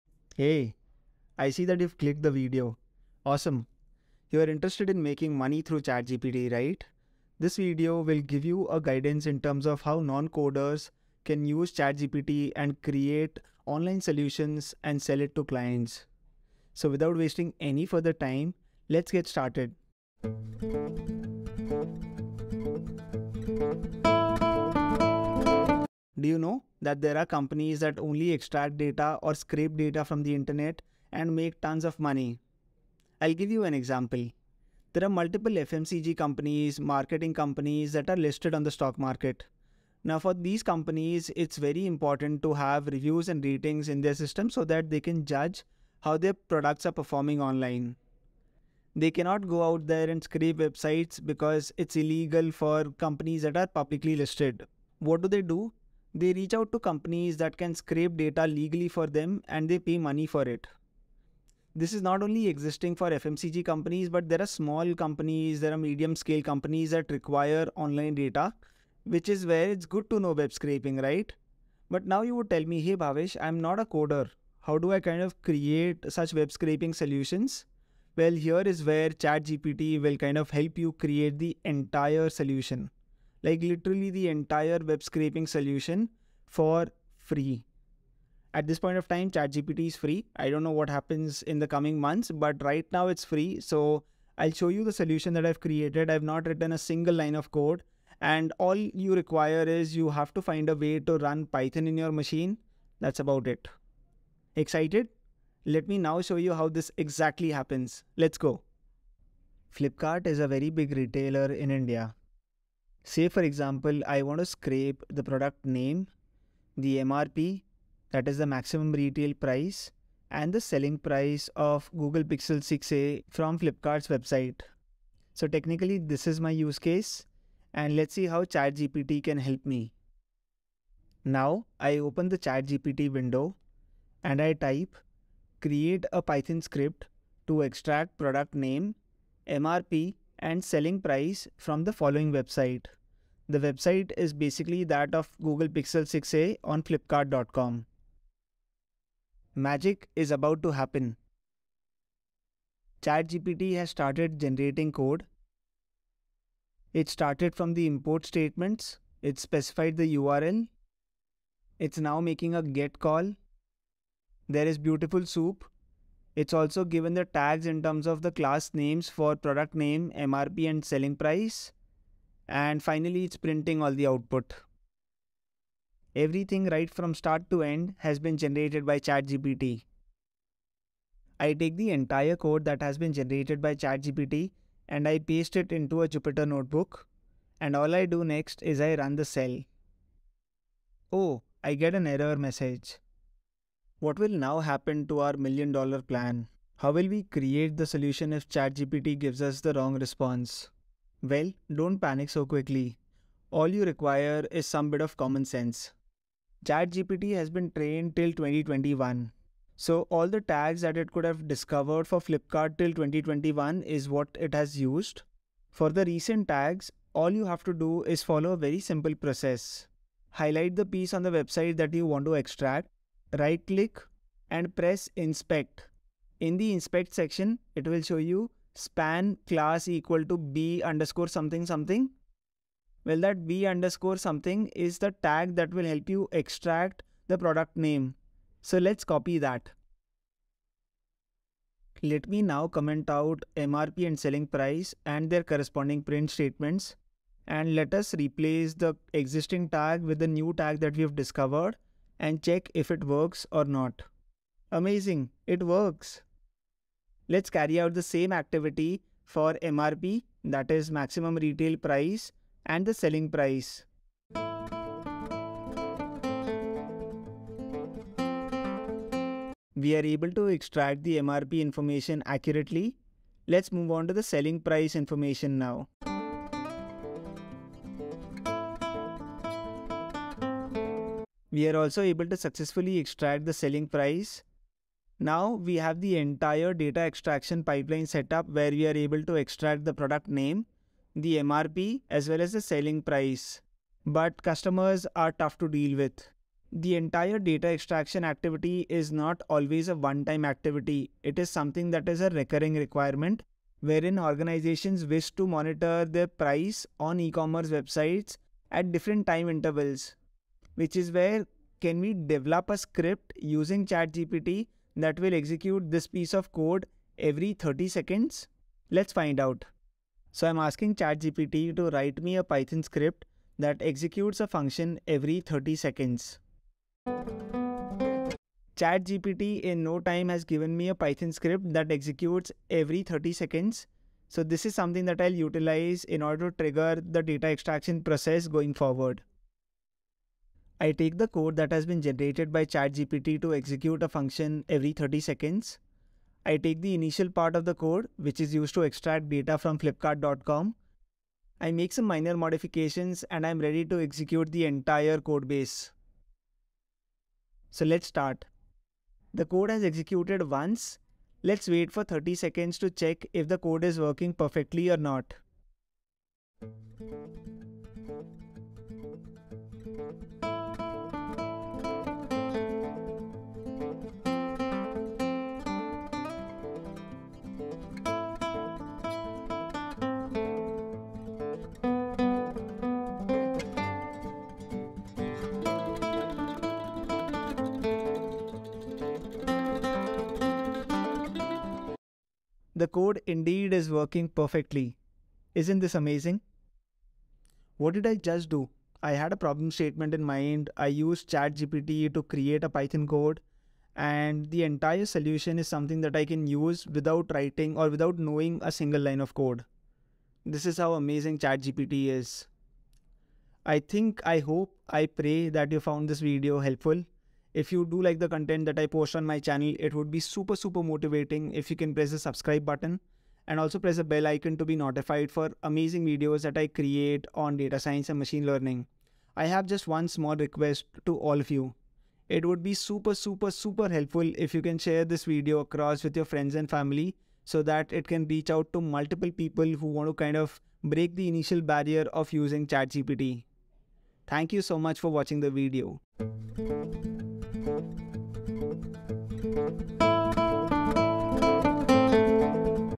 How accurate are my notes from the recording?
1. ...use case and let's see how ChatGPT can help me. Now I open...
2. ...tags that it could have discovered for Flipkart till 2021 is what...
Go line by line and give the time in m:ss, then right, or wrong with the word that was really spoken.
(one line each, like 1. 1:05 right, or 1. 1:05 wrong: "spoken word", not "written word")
1. 2:06 right
2. 3:30 right.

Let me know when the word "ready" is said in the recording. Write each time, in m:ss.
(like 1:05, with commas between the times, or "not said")
5:53.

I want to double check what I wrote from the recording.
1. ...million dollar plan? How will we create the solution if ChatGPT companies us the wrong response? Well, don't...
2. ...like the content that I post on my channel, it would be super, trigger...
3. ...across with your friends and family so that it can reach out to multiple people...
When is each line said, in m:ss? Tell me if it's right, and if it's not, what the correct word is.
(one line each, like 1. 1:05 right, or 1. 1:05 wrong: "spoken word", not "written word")
1. 3:15 wrong: "gives", not "companies"
2. 6:58 wrong: "super", not "trigger"
3. 7:15 right.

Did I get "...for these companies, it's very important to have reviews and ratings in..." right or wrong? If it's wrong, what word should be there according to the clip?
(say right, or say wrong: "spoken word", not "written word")
right.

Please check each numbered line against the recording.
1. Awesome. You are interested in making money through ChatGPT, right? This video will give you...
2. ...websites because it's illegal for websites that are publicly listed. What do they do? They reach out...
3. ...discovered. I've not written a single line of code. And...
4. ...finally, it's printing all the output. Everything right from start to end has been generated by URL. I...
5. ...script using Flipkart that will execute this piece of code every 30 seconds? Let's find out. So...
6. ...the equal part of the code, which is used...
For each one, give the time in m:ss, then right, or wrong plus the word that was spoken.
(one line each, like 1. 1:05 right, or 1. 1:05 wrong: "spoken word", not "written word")
1. 0:03 right
2. 0:50 wrong: "companies", not "websites"
3. 1:35 wrong: "created", not "discovered"
4. 2:52 wrong: "ChatGPT", not "URL"
5. 5:12 wrong: "ChatGPT", not "Flipkart"
6. 5:46 wrong: "initial", not "equal".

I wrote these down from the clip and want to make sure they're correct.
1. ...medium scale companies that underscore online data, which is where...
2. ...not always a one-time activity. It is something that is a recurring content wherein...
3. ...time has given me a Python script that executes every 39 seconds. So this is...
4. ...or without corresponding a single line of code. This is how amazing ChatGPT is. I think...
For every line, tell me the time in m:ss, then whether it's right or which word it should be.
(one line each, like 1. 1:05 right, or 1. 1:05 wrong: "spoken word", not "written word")
1. 1:05 wrong: "require", not "underscore"
2. 4:59 wrong: "requirement", not "content"
3. 5:30 wrong: "30", not "39"
4. 6:47 wrong: "knowing", not "corresponding".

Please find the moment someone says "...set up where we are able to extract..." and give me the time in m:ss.
4:48.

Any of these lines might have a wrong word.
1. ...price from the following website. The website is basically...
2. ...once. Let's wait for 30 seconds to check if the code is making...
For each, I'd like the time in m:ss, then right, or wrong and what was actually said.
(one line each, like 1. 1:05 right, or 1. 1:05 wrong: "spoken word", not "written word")
1. 2:20 right
2. 6:00 wrong: "working", not "making".